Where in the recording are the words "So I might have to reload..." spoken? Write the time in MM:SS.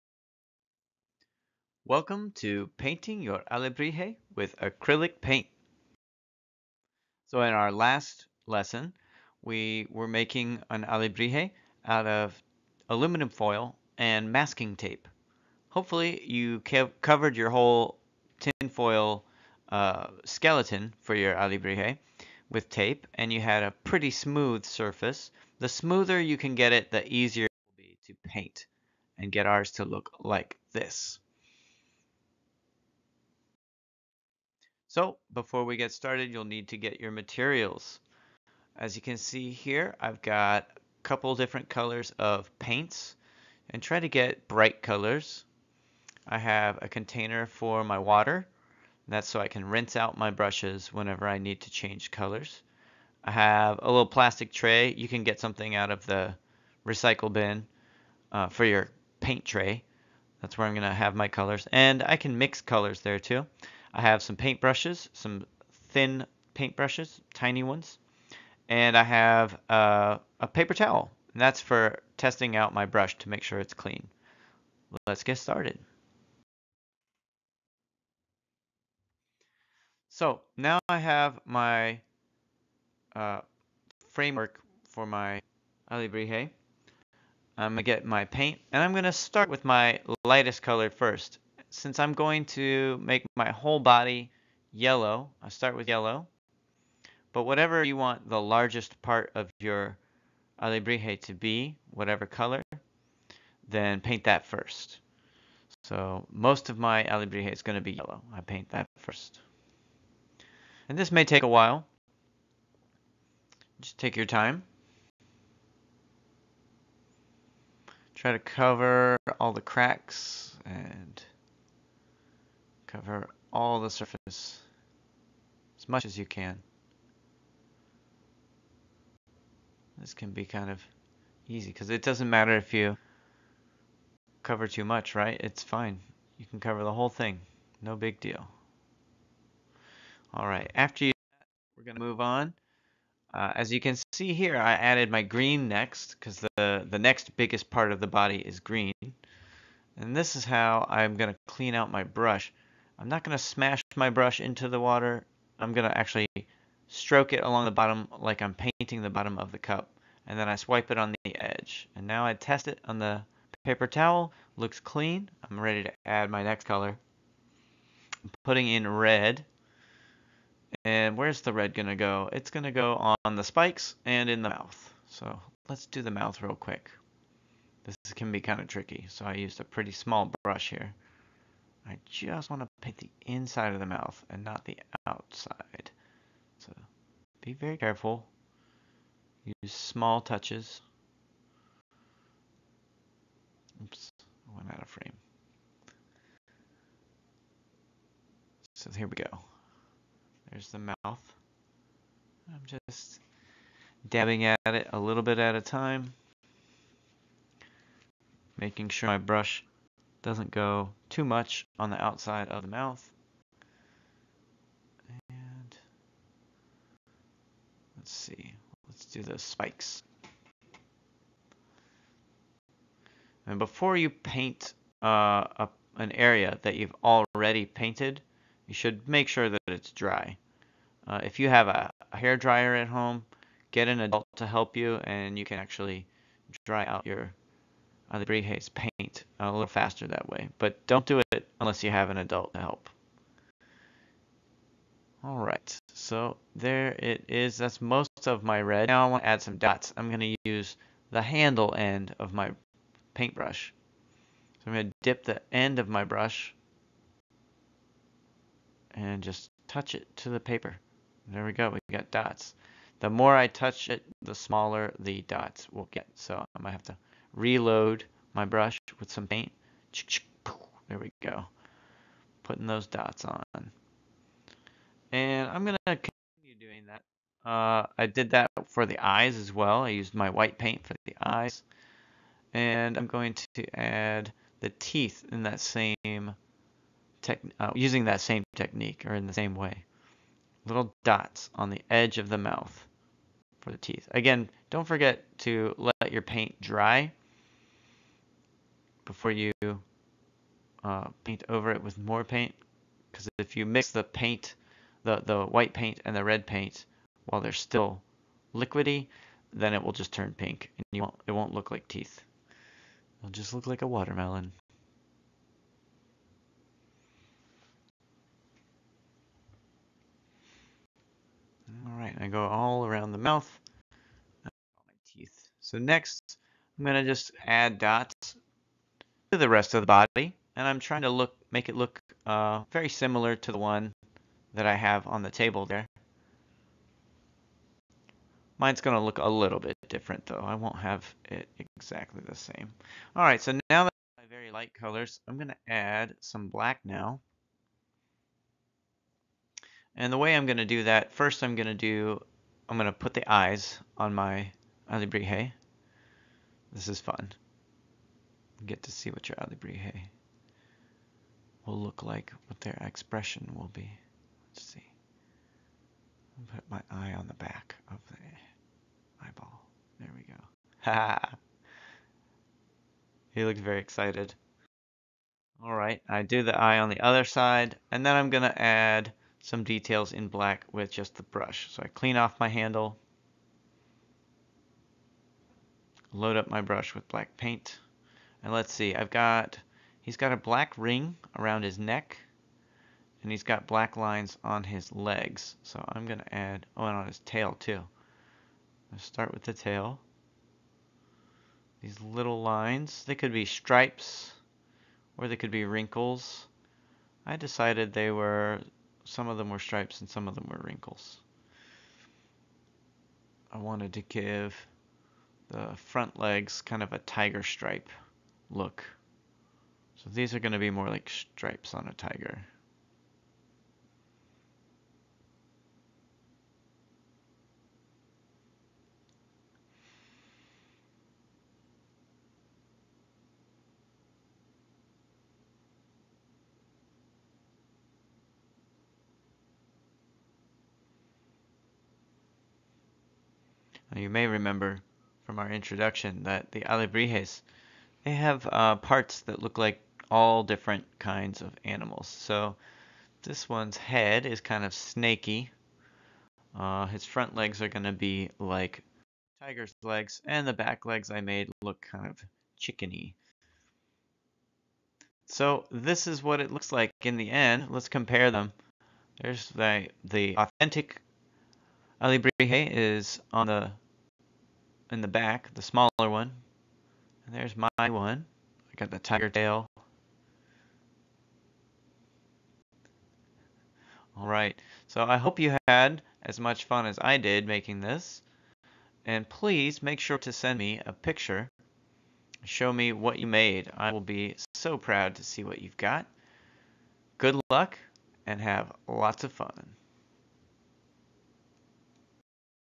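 04:26.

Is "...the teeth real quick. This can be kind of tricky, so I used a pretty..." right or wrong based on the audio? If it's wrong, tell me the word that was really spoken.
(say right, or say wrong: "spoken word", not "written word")
wrong: "mouth", not "teeth".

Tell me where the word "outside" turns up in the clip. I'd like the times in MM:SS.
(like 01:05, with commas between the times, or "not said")
03:05, 03:32.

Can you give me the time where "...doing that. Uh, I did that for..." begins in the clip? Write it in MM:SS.
04:36.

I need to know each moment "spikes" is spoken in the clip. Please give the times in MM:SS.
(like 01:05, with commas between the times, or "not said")
02:53, 03:39.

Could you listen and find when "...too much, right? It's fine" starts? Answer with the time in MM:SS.
02:14.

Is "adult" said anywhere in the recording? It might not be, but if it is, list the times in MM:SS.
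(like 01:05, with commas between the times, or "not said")
03:54, 04:02.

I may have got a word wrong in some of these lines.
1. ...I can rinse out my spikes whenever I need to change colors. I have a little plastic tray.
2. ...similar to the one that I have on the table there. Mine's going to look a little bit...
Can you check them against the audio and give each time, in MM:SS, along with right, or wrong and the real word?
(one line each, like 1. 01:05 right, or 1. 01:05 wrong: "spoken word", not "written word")
1. 00:49 wrong: "brushes", not "spikes"
2. 05:32 right.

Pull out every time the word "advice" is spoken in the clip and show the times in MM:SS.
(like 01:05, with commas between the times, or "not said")
not said.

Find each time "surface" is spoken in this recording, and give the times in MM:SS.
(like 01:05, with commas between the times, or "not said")
00:24, 02:03.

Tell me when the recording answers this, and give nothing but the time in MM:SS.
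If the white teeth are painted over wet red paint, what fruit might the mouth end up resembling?
05:13.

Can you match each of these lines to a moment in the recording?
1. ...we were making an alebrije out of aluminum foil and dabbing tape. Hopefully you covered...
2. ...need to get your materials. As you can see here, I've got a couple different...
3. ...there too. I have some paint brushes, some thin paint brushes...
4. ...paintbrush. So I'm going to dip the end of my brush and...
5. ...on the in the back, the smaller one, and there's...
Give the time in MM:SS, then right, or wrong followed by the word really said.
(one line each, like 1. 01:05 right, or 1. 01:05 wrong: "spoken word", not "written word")
1. 00:09 wrong: "masking", not "dabbing"
2. 00:36 right
3. 01:02 right
4. 04:13 right
5. 07:53 right.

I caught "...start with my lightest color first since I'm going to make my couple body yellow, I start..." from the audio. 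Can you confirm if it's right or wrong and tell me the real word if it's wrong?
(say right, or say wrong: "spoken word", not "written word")
wrong: "whole", not "couple".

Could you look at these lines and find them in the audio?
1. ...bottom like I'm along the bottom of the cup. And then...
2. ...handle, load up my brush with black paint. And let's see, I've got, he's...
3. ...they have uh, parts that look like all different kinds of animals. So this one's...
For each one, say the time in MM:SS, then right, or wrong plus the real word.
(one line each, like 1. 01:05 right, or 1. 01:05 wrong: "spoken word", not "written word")
1. 02:37 wrong: "painting", not "along"
2. 06:22 right
3. 07:28 right.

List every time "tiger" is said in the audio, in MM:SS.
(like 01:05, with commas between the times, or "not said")
06:56, 07:01, 07:39, 07:58.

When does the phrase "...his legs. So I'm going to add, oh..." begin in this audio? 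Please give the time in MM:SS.
06:34.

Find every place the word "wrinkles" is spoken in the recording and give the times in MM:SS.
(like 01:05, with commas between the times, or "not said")
06:45, 06:50.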